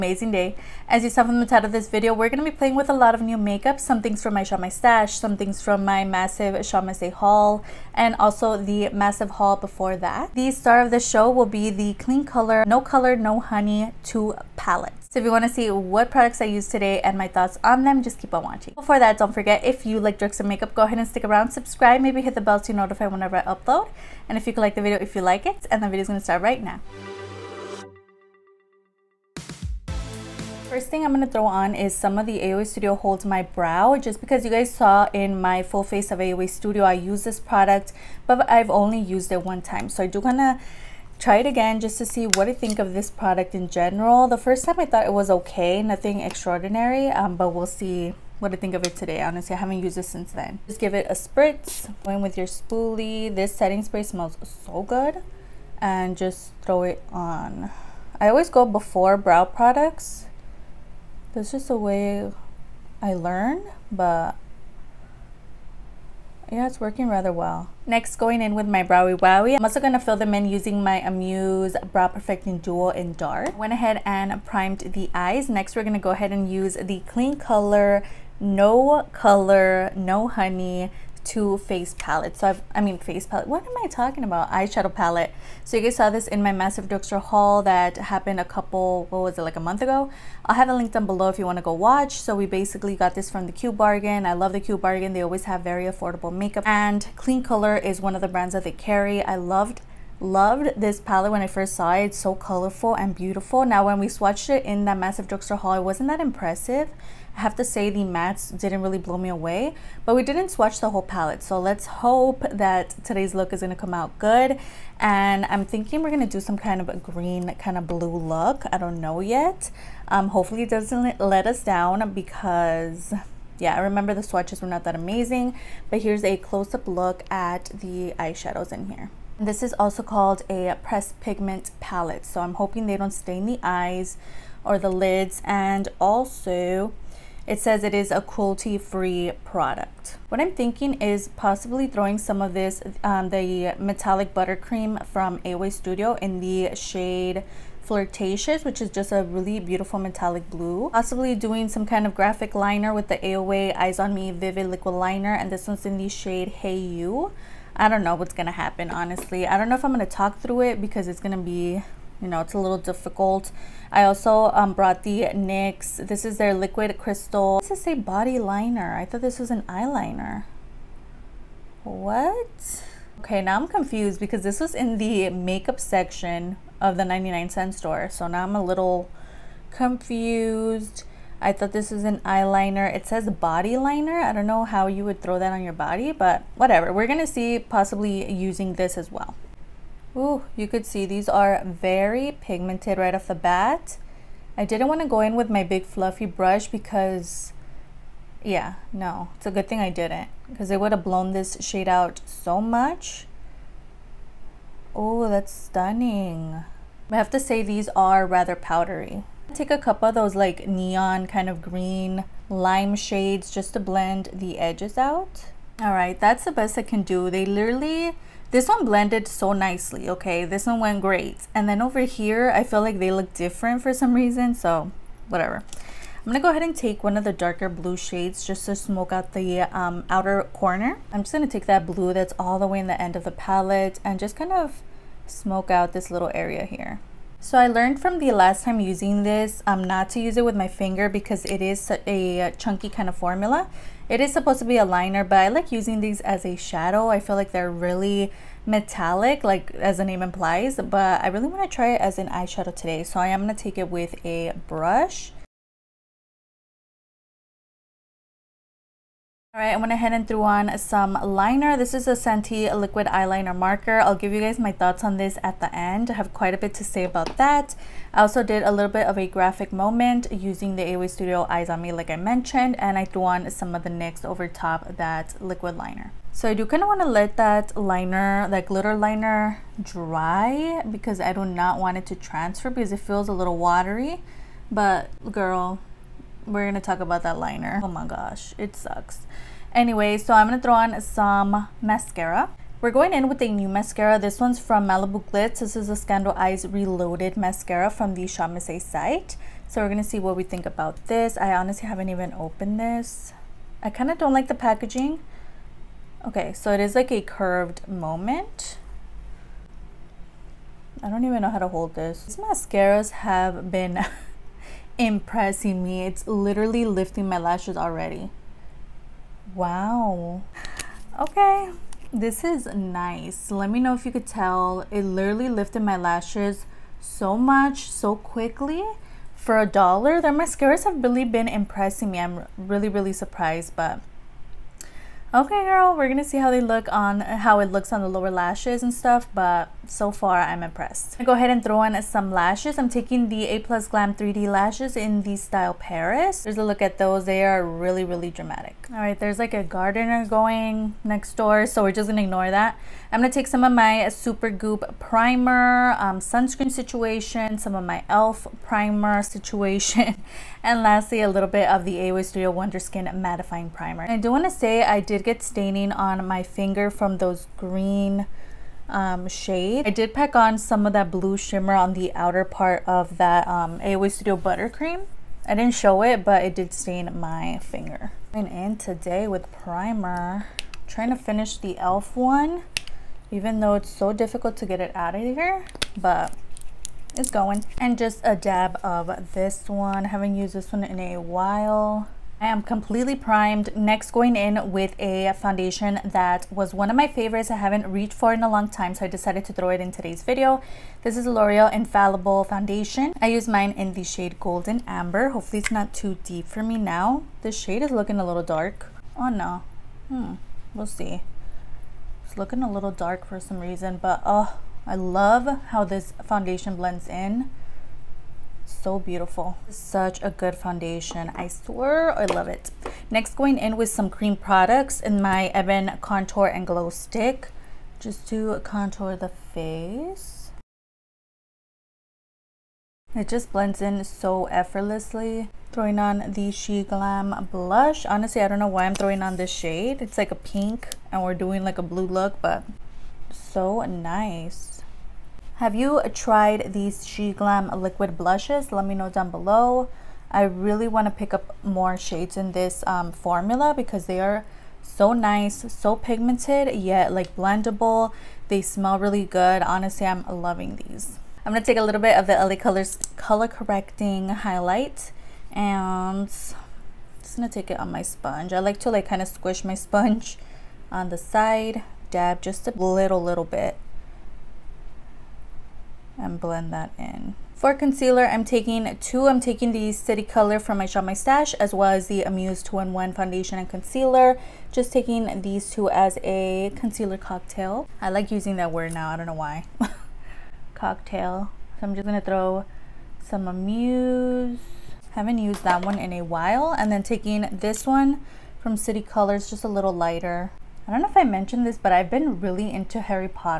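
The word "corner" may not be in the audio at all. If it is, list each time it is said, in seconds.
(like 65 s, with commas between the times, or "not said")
230 s.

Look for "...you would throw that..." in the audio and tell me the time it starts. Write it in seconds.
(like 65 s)
184 s.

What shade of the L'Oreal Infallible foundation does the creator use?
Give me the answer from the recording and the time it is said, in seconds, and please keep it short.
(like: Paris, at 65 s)
Golden Amber, at 404 s.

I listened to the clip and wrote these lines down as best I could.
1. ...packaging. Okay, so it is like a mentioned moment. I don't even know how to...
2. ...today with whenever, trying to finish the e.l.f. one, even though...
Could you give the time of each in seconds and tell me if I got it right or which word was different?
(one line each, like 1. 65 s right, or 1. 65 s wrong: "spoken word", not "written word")
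1. 304 s wrong: "curved", not "mentioned"
2. 378 s wrong: "primer", not "whenever".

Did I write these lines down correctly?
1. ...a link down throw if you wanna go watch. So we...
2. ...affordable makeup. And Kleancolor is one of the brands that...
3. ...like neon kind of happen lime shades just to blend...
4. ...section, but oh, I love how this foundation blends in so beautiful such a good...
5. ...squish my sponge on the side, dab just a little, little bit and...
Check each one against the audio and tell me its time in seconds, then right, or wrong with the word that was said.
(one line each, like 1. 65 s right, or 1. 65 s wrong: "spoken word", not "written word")
1. 90 s wrong: "below", not "throw"
2. 95 s right
3. 210 s wrong: "green", not "happen"
4. 413 s wrong: "reason", not "section"
5. 469 s right.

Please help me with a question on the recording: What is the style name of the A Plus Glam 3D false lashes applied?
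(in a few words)
Paris.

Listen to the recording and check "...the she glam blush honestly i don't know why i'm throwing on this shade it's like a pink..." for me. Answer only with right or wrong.
right.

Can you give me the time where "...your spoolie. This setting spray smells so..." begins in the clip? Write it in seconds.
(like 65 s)
52 s.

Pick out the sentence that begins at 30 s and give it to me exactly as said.
First thing I'm going to throw on is some of the AOA Studio Hold My Brow.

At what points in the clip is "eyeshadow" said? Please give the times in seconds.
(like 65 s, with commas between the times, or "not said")
84 s, 128 s, 252 s.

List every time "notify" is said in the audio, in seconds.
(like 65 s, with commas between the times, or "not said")
22 s.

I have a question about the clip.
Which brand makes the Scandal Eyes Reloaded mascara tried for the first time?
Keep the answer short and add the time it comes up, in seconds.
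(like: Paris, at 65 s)
Malibu Glitz, at 294 s.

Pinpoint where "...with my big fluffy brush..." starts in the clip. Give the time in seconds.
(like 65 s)
195 s.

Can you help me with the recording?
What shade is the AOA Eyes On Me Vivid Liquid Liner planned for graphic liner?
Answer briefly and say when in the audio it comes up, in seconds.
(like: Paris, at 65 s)
Hey You, at 156 s.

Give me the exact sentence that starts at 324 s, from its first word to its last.
It literally lifted my lashes so much, so quickly.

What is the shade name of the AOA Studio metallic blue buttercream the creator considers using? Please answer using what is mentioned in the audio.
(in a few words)
Flirtatious.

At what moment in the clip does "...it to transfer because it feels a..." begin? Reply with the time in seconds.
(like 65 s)
281 s.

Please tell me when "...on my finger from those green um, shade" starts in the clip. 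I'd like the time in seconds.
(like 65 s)
365 s.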